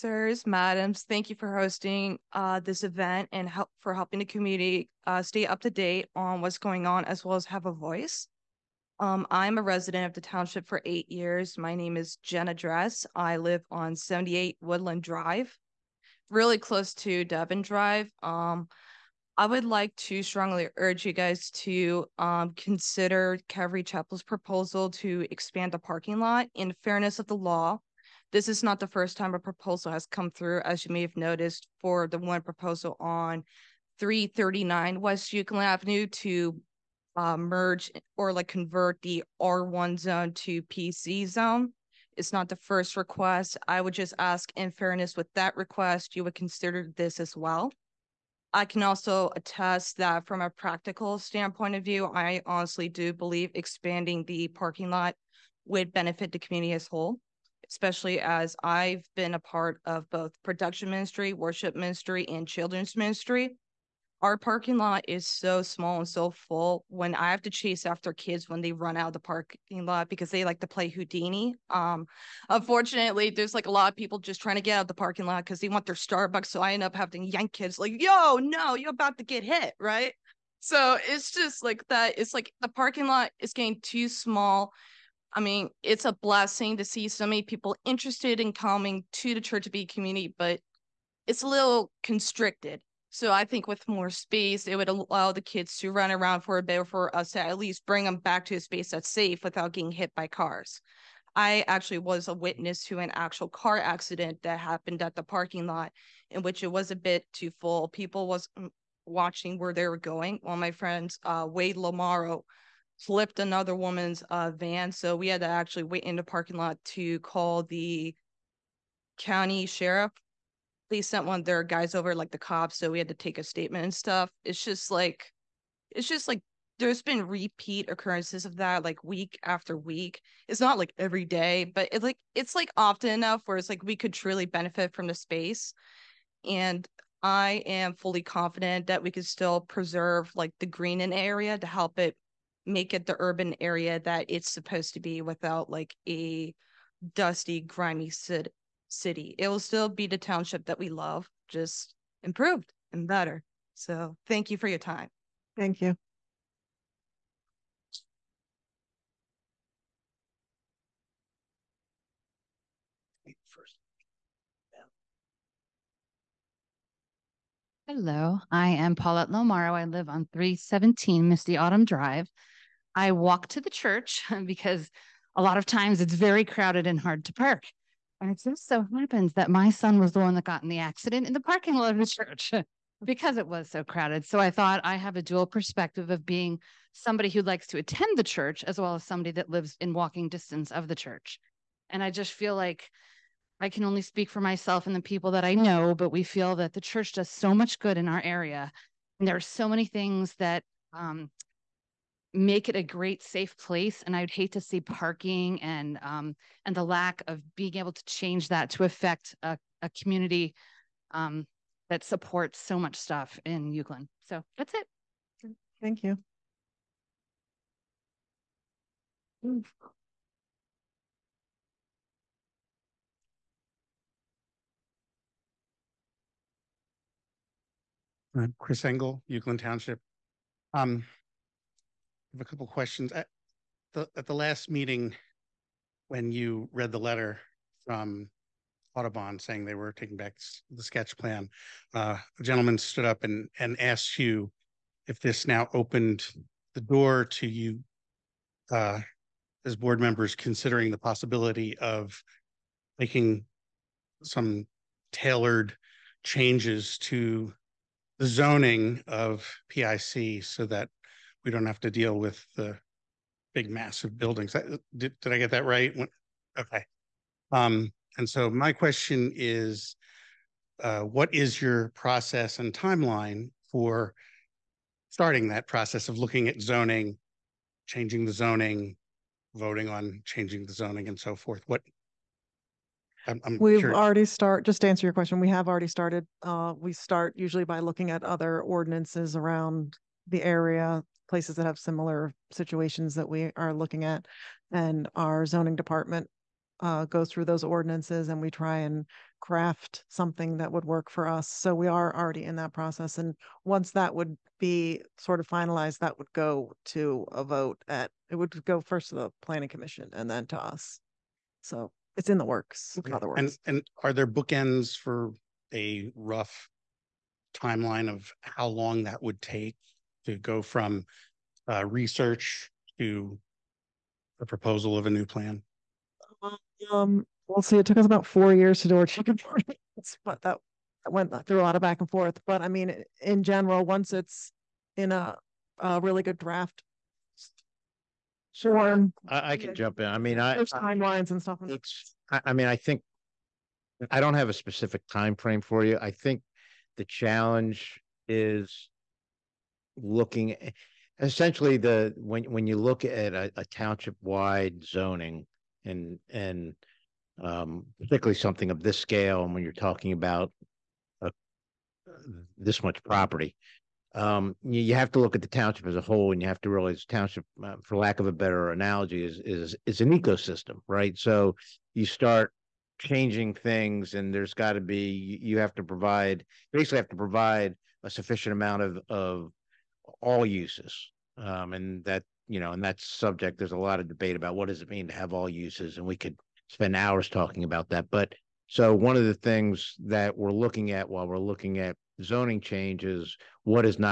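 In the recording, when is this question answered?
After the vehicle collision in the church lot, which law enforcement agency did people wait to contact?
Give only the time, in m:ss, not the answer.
1:59.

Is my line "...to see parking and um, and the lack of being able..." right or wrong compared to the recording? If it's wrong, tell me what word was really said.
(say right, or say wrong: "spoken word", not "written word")
right.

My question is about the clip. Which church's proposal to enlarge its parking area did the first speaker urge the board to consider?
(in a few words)
Calvary Chapel.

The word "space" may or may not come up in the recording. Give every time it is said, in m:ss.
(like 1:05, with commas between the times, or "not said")
1:34, 1:38, 2:15.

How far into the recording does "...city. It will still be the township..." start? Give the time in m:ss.
2:28.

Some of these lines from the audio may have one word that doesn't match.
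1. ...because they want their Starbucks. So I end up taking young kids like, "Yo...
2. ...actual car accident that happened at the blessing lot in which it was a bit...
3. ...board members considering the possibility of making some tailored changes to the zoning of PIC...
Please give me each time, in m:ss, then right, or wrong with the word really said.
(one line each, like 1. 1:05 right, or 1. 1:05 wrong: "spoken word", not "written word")
1. 1:15 wrong: "having", not "taking"
2. 1:43 wrong: "parking", not "blessing"
3. 4:09 right.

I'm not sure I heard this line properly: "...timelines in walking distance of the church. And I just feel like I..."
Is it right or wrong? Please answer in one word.
wrong.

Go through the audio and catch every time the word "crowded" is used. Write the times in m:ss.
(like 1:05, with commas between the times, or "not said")
2:56, 3:03.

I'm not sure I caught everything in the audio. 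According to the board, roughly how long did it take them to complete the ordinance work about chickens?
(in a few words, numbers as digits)
4 years.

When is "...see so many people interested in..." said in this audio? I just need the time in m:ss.
1:26.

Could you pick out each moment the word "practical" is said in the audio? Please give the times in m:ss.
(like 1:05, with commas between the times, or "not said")
0:50.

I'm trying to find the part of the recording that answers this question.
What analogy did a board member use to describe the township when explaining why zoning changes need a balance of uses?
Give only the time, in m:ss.
6:10.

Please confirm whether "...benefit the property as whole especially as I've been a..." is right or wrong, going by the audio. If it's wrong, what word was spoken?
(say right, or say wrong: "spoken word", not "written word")
wrong: "community", not "property".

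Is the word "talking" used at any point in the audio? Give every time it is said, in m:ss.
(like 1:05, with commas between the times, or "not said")
5:59, 6:27.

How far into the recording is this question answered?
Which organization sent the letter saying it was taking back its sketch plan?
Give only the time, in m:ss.
3:58.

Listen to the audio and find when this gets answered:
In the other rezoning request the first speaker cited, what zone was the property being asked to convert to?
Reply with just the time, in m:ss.
0:40.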